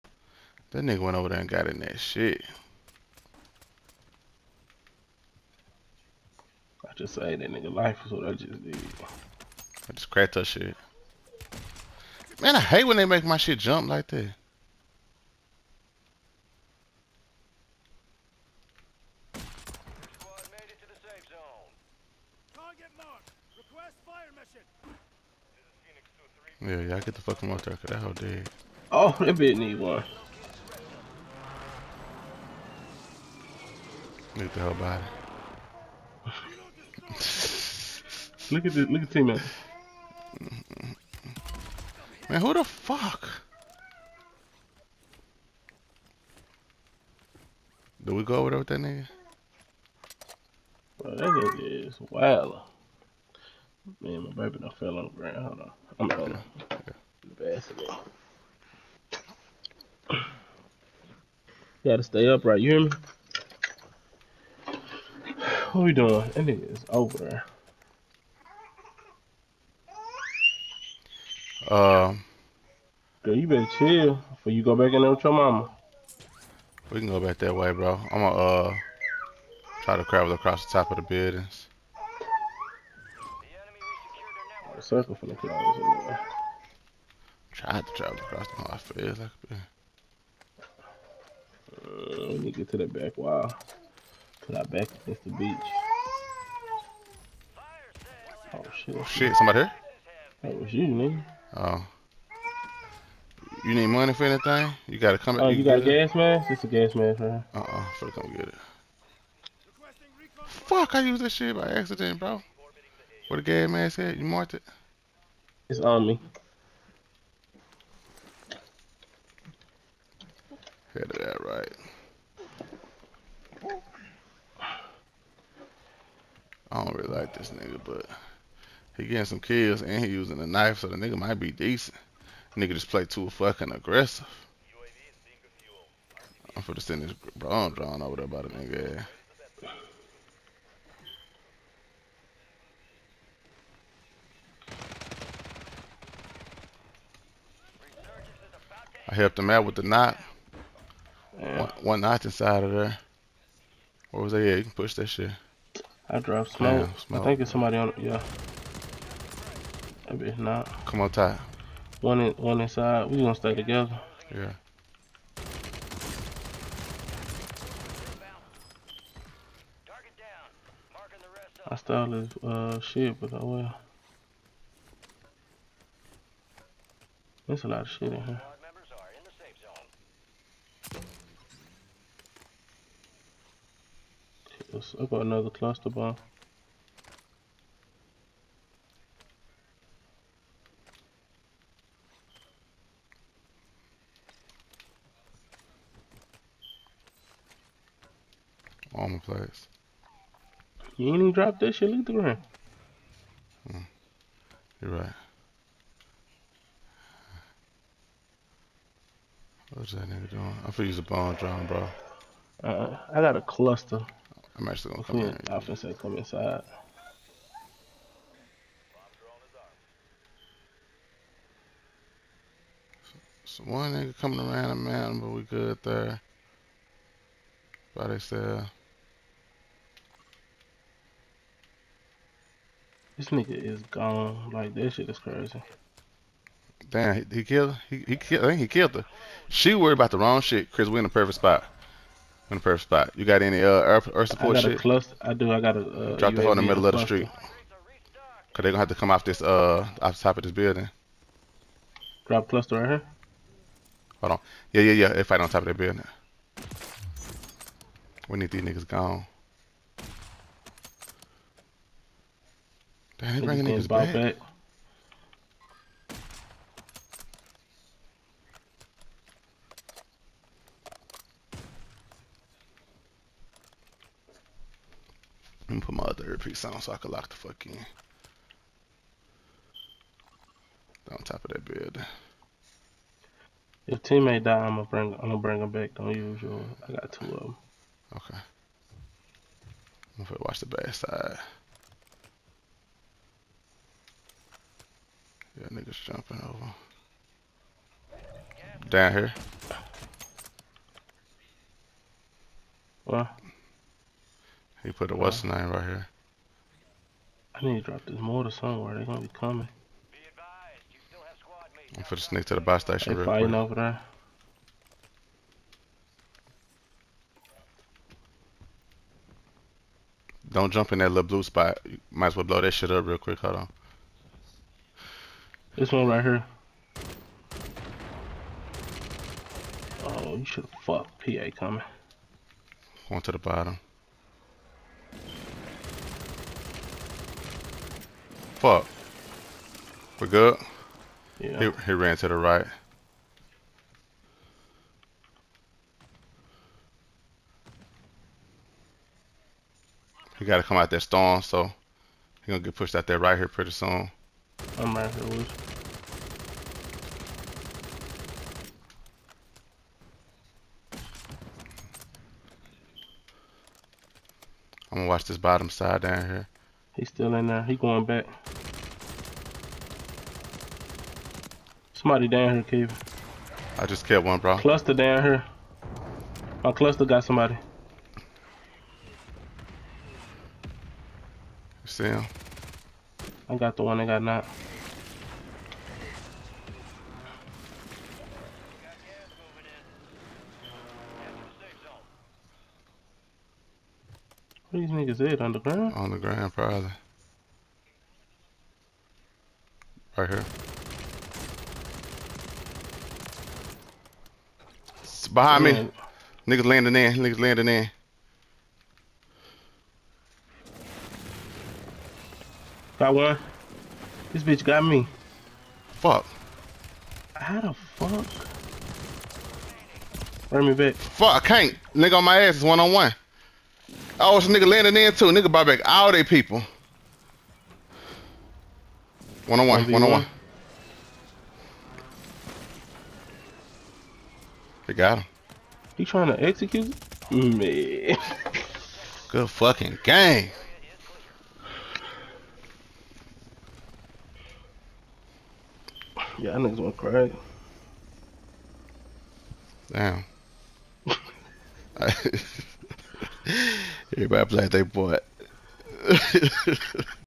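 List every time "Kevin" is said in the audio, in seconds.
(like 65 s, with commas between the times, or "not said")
372 s.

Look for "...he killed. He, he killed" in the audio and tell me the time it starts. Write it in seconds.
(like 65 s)
237 s.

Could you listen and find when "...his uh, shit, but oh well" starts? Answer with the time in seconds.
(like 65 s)
172 s.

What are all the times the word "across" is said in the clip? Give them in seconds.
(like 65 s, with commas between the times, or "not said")
80 s, 88 s.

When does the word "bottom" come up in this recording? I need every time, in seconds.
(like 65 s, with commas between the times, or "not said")
333 s, 365 s.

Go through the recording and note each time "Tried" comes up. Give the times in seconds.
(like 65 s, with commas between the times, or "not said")
87 s.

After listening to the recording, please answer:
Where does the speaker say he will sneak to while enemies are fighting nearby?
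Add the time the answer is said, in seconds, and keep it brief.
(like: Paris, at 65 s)
bus station, at 312 s.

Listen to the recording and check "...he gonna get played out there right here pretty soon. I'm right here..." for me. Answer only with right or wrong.
wrong.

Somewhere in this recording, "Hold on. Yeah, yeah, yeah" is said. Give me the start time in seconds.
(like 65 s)
254 s.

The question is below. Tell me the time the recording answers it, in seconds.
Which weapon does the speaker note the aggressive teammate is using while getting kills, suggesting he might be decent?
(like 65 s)
130 s.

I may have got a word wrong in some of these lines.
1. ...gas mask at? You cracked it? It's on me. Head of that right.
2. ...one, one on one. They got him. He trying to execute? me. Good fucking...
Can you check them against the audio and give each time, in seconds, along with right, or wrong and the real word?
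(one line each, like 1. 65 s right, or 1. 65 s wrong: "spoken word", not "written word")
1. 113 s wrong: "marked", not "cracked"
2. 429 s right.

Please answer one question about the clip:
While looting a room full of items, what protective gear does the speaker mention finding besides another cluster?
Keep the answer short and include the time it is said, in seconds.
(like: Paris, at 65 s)
Armor plates, at 198 s.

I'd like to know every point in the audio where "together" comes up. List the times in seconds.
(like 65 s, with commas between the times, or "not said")
163 s.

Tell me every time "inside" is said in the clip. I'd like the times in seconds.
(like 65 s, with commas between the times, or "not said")
152 s, 162 s, 216 s.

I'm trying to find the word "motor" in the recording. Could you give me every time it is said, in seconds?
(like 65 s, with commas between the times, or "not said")
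27 s, 308 s.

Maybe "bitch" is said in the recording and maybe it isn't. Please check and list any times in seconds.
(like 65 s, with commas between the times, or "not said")
29 s, 414 s.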